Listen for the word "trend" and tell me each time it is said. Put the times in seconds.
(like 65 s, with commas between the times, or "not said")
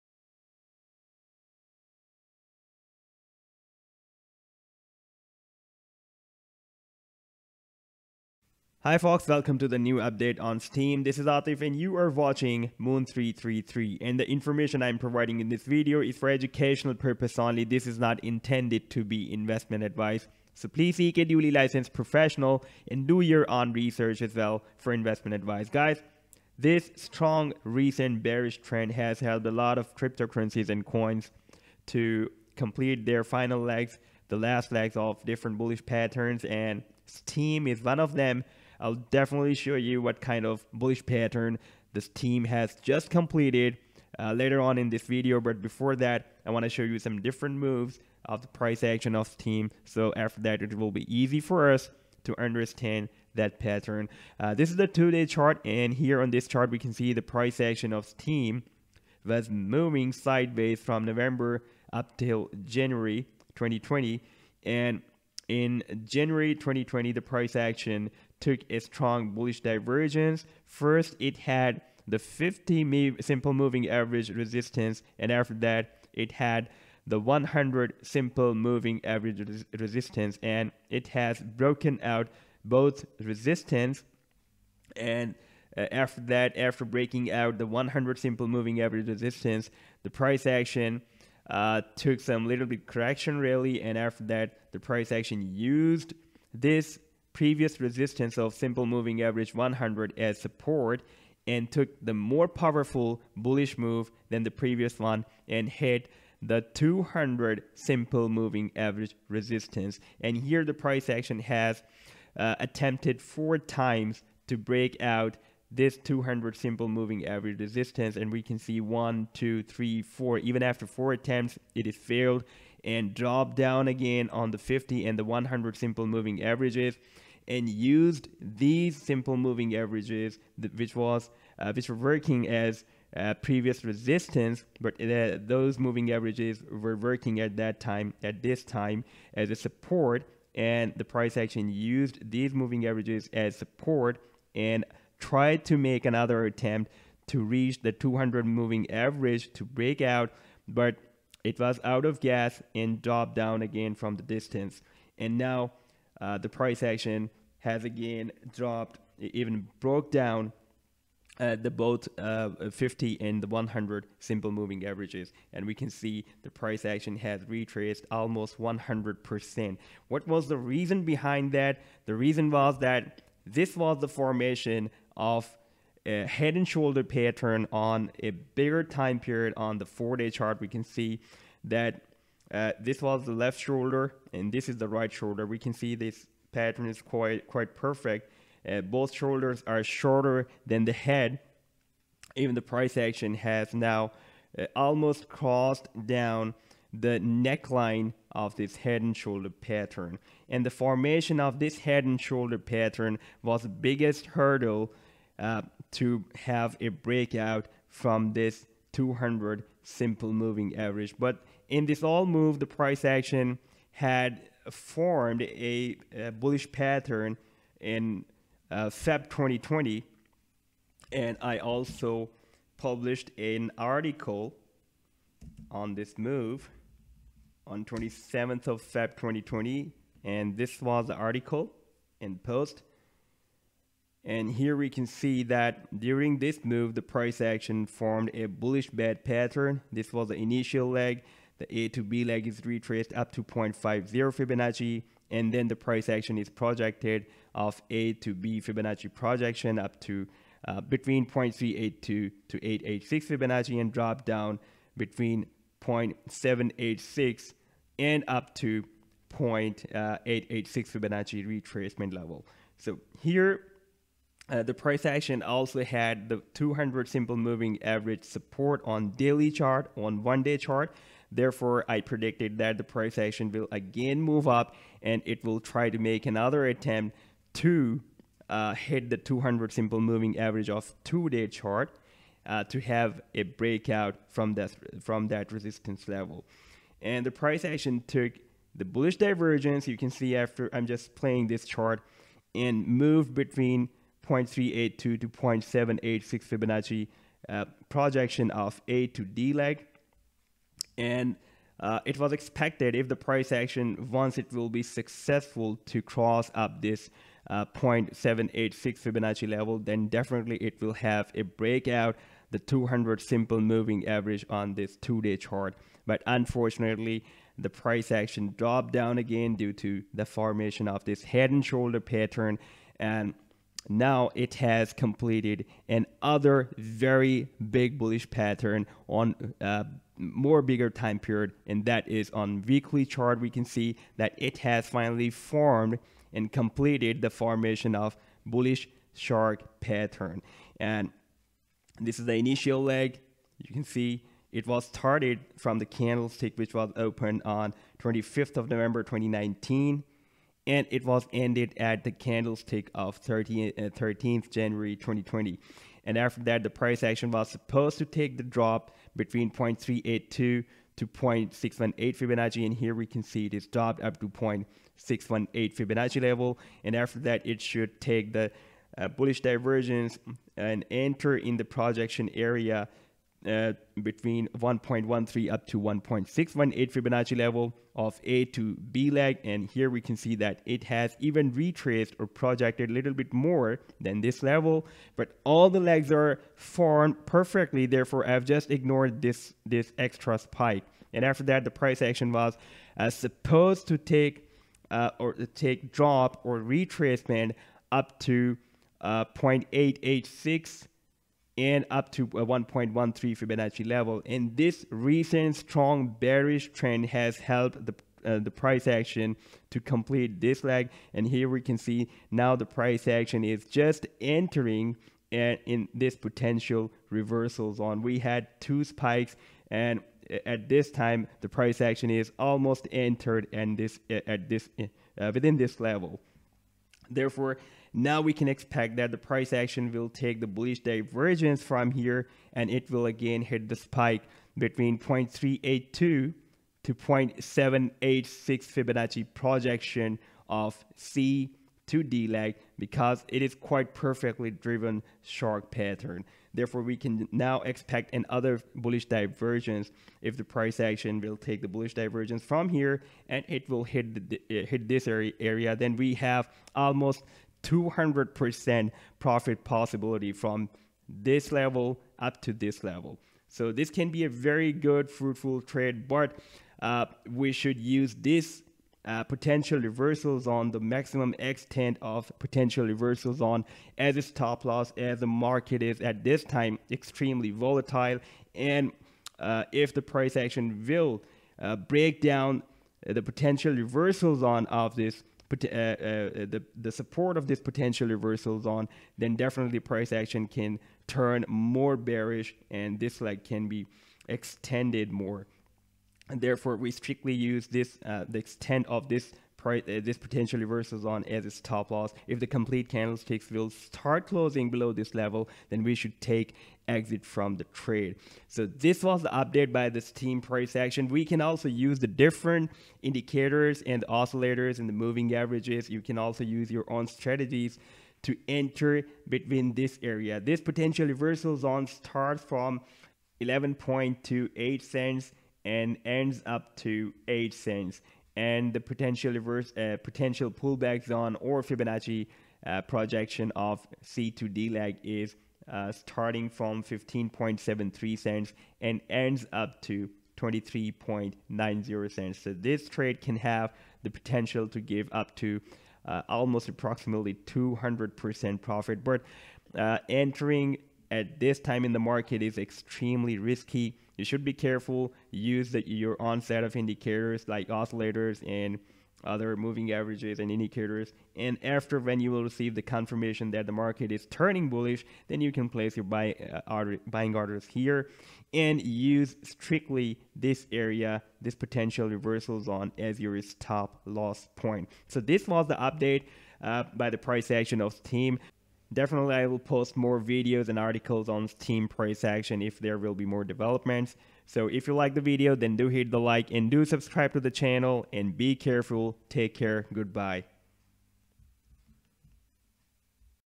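28 s, 406 s.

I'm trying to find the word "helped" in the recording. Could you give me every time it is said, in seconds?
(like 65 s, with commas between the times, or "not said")
29 s, 407 s.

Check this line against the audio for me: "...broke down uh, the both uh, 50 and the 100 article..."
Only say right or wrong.
wrong.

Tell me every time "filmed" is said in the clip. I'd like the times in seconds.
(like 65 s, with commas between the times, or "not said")
not said.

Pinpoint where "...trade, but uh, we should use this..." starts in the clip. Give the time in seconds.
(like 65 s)
465 s.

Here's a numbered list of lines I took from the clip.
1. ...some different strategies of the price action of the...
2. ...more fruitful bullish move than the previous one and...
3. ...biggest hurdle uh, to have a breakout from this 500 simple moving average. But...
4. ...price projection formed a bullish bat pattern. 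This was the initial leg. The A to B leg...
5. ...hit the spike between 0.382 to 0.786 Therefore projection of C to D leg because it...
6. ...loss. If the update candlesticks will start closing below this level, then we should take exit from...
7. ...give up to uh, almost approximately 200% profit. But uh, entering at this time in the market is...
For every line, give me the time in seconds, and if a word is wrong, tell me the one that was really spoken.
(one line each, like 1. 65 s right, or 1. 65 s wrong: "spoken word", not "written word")
1. 46 s wrong: "moves", not "strategies"
2. 102 s wrong: "powerful", not "fruitful"
3. 203 s wrong: "200", not "500"
4. 237 s wrong: "action", not "projection"
5. 433 s wrong: "Fibonacci", not "Therefore"
6. 501 s wrong: "complete", not "update"
7. 544 s right.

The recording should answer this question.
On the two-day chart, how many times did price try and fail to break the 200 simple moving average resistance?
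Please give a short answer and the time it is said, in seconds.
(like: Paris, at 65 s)
4, at 113 s.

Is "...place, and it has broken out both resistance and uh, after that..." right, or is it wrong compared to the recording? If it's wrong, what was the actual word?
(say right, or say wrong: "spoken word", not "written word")
wrong: "resistance", not "place".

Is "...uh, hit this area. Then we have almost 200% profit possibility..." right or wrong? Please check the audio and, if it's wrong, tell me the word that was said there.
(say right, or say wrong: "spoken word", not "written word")
right.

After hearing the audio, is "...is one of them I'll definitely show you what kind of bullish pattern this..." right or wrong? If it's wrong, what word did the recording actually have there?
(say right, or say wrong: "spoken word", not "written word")
right.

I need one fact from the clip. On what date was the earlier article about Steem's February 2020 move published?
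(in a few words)
27 February 2020.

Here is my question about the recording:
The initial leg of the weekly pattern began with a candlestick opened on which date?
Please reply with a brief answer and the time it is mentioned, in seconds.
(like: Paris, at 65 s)
25 November 2019, at 347 s.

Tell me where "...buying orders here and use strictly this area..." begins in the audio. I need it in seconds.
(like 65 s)
567 s.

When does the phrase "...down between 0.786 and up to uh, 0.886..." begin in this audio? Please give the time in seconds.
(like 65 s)
254 s.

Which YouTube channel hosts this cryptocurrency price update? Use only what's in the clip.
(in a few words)
Moon333.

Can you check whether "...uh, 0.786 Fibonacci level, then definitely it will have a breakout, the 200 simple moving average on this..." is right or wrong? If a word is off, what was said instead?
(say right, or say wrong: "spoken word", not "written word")
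right.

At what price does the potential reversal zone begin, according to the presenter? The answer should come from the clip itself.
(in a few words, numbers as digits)
11.28 cents.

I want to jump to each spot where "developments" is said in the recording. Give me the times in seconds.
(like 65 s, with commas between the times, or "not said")
583 s.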